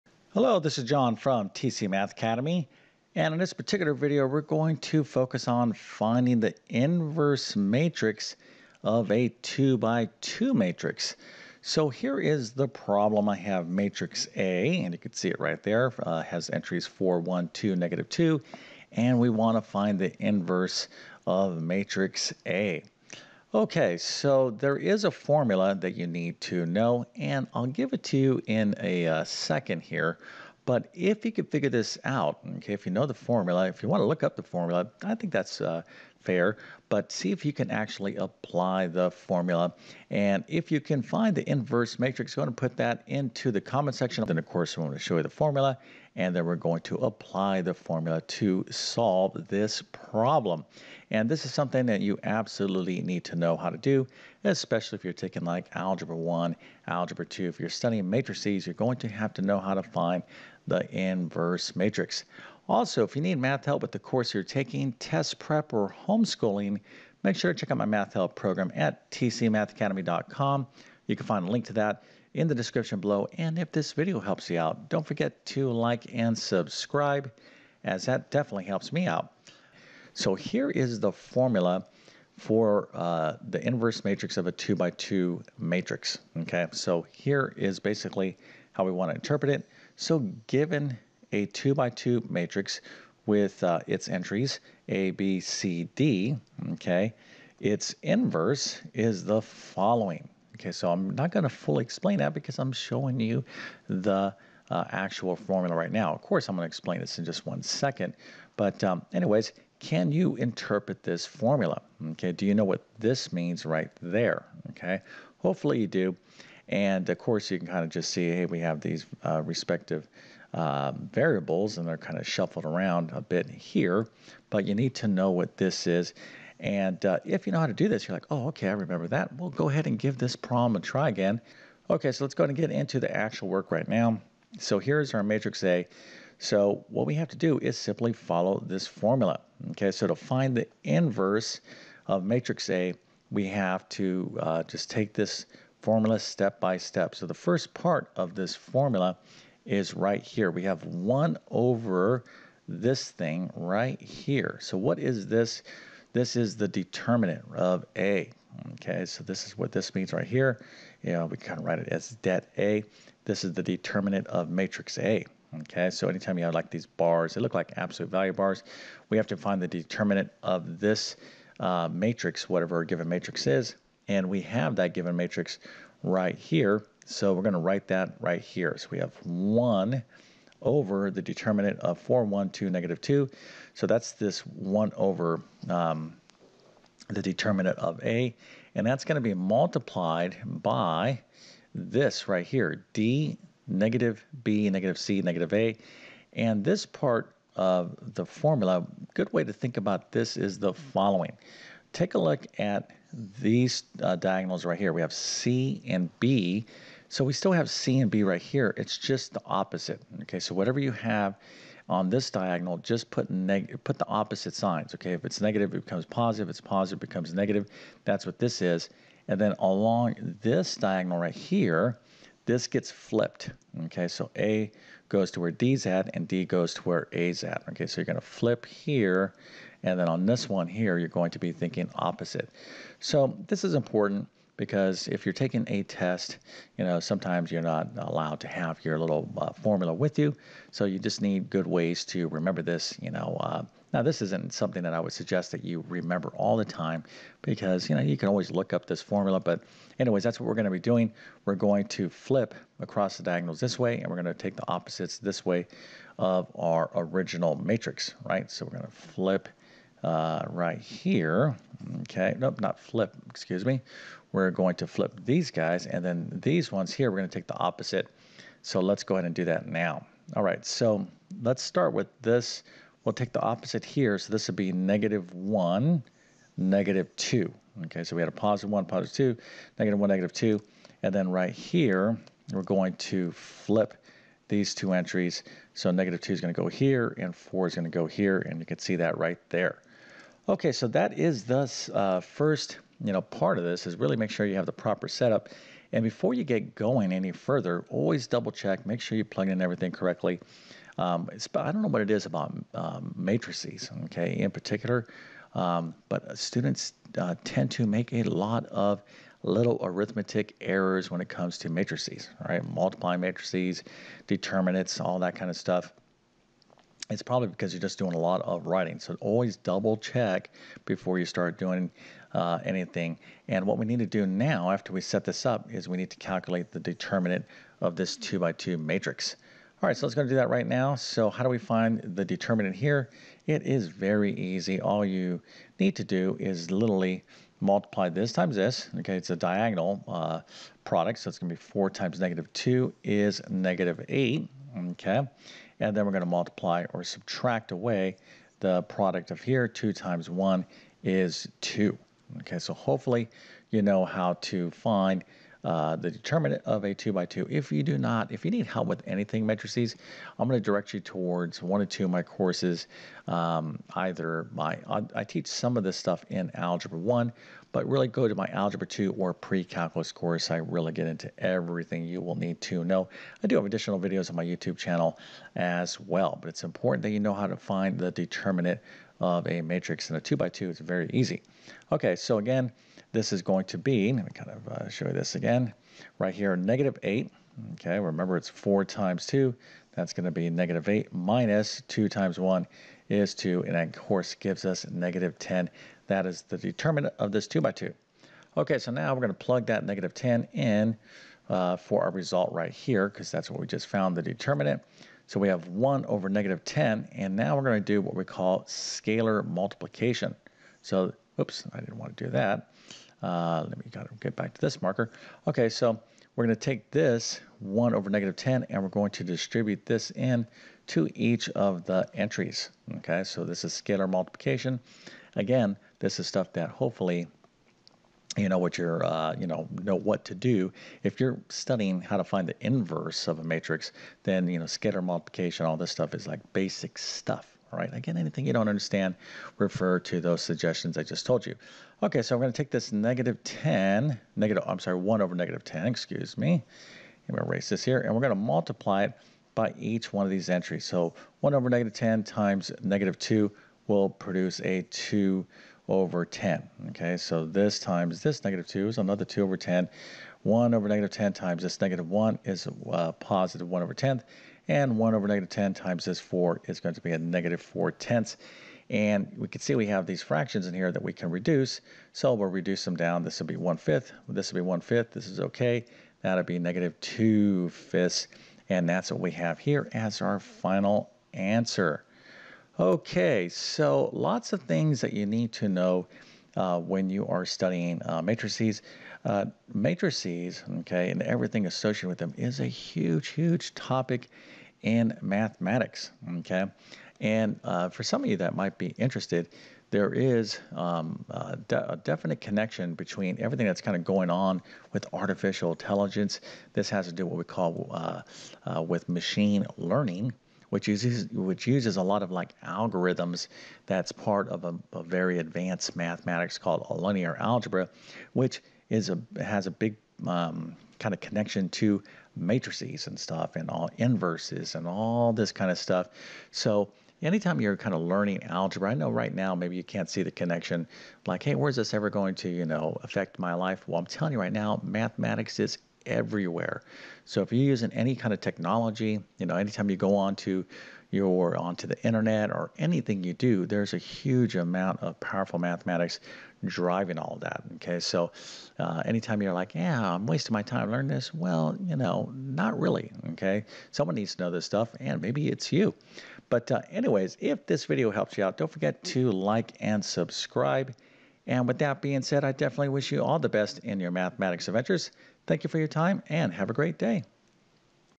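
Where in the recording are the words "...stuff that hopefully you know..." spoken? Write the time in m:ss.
7:06.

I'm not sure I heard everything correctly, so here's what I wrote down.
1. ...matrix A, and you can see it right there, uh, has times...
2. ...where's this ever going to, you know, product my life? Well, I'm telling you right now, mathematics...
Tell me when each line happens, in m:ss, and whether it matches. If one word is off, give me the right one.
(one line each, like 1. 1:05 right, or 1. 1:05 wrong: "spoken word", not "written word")
1. 0:13 wrong: "entries", not "times"
2. 8:51 wrong: "affect", not "product".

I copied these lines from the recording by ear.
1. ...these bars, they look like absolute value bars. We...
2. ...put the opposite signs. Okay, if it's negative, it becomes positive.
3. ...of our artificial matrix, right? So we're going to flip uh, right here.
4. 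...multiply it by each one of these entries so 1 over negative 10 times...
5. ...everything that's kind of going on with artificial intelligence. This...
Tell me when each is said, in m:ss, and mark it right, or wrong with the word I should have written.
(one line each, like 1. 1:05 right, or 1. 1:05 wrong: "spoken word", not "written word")
1. 2:46 right
2. 3:33 right
3. 4:16 wrong: "original", not "artificial"
4. 7:28 right
5. 8:23 right.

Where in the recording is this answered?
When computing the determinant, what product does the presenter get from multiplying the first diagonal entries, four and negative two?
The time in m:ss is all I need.
5:43.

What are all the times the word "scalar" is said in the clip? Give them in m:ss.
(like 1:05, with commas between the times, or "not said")
6:48, 7:03, 7:14.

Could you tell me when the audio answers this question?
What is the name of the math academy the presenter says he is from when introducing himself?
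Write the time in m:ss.
0:01.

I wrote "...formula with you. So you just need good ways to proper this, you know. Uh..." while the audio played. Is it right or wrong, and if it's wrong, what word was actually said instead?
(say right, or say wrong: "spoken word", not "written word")
wrong: "remember", not "proper".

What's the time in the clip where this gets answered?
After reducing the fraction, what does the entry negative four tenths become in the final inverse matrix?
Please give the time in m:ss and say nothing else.
7:56.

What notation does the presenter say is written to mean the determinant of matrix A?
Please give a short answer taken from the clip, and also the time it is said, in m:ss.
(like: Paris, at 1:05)
det A, at 2:42.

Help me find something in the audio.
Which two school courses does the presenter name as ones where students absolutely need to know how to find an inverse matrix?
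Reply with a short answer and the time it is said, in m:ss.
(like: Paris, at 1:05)
Algebra 1, Algebra 2, at 0:55.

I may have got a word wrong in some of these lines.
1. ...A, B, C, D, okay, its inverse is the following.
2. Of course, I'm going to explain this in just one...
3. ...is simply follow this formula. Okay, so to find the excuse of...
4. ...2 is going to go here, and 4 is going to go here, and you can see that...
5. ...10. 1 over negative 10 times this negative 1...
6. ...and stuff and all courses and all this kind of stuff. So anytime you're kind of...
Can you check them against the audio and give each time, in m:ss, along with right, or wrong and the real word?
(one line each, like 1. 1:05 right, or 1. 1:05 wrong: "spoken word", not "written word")
1. 1:34 right
2. 1:46 right
3. 2:17 wrong: "inverse", not "excuse"
4. 4:46 right
5. 7:39 right
6. 8:43 wrong: "inverses", not "courses".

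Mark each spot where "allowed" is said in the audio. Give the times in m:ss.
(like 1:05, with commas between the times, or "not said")
3:57.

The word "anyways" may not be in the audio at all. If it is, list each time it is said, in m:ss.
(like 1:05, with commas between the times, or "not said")
1:49, 4:09, 9:16.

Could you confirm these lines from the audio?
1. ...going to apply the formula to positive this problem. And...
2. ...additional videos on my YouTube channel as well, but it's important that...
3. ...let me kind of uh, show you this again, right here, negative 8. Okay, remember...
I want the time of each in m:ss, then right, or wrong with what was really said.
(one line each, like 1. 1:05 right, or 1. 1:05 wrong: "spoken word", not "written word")
1. 0:46 wrong: "solve", not "positive"
2. 6:13 right
3. 6:24 right.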